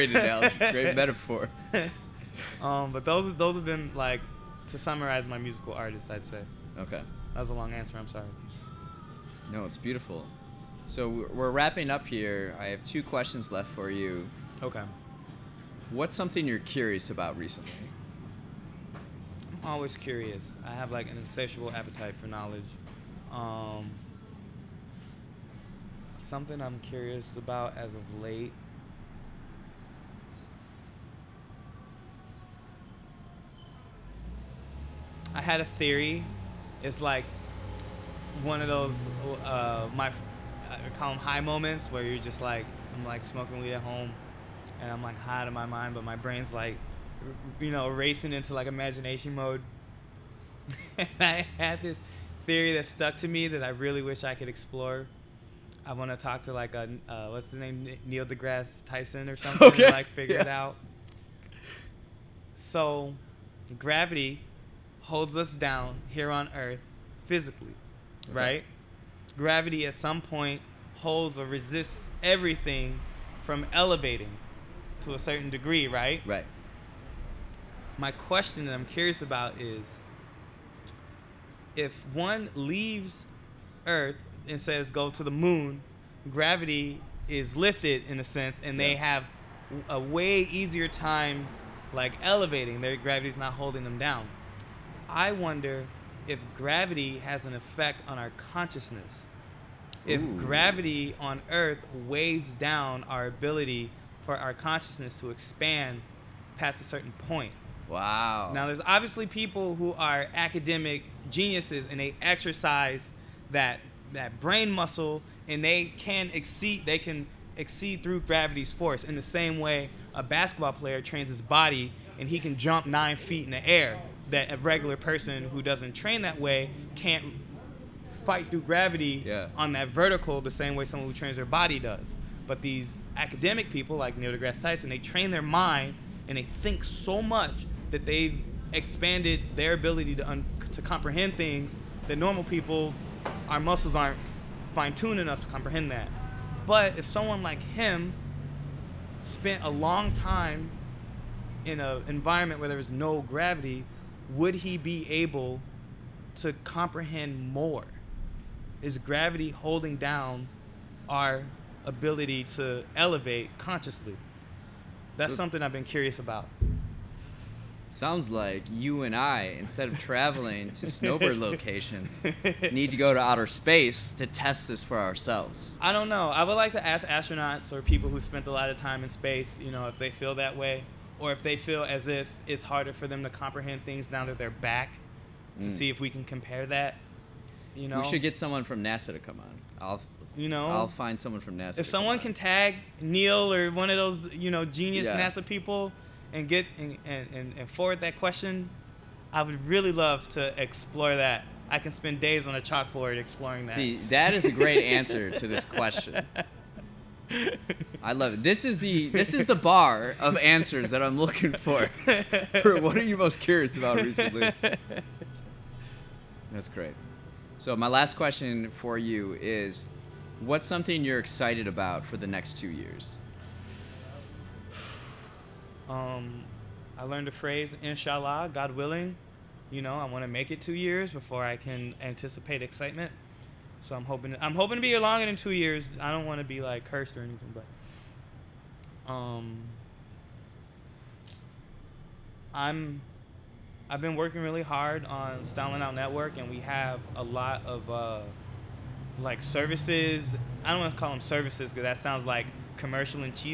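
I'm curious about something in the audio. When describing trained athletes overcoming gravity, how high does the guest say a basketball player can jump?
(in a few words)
9 feet.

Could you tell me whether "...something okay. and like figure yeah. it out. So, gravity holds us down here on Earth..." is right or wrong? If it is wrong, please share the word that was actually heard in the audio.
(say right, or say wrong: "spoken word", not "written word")
right.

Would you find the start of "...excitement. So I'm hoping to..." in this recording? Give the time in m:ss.
3:52.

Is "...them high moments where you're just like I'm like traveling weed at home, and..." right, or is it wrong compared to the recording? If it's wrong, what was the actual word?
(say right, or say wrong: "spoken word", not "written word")
wrong: "smoking", not "traveling".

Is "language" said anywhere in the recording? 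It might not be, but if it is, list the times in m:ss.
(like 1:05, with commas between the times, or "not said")
not said.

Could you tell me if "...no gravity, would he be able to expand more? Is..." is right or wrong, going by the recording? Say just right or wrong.
wrong.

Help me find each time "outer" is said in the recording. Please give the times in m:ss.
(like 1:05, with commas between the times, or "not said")
2:53.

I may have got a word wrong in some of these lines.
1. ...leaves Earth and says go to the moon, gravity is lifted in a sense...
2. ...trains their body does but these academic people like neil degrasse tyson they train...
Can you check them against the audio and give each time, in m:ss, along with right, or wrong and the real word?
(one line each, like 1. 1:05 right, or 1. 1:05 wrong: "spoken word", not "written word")
1. 1:22 right
2. 2:11 right.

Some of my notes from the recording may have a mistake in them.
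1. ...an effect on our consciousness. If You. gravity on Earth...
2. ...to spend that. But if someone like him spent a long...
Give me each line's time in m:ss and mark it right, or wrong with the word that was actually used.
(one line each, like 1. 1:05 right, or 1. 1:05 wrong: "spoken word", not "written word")
1. 1:37 wrong: "Ooh", not "You"
2. 2:25 wrong: "comprehend", not "spend".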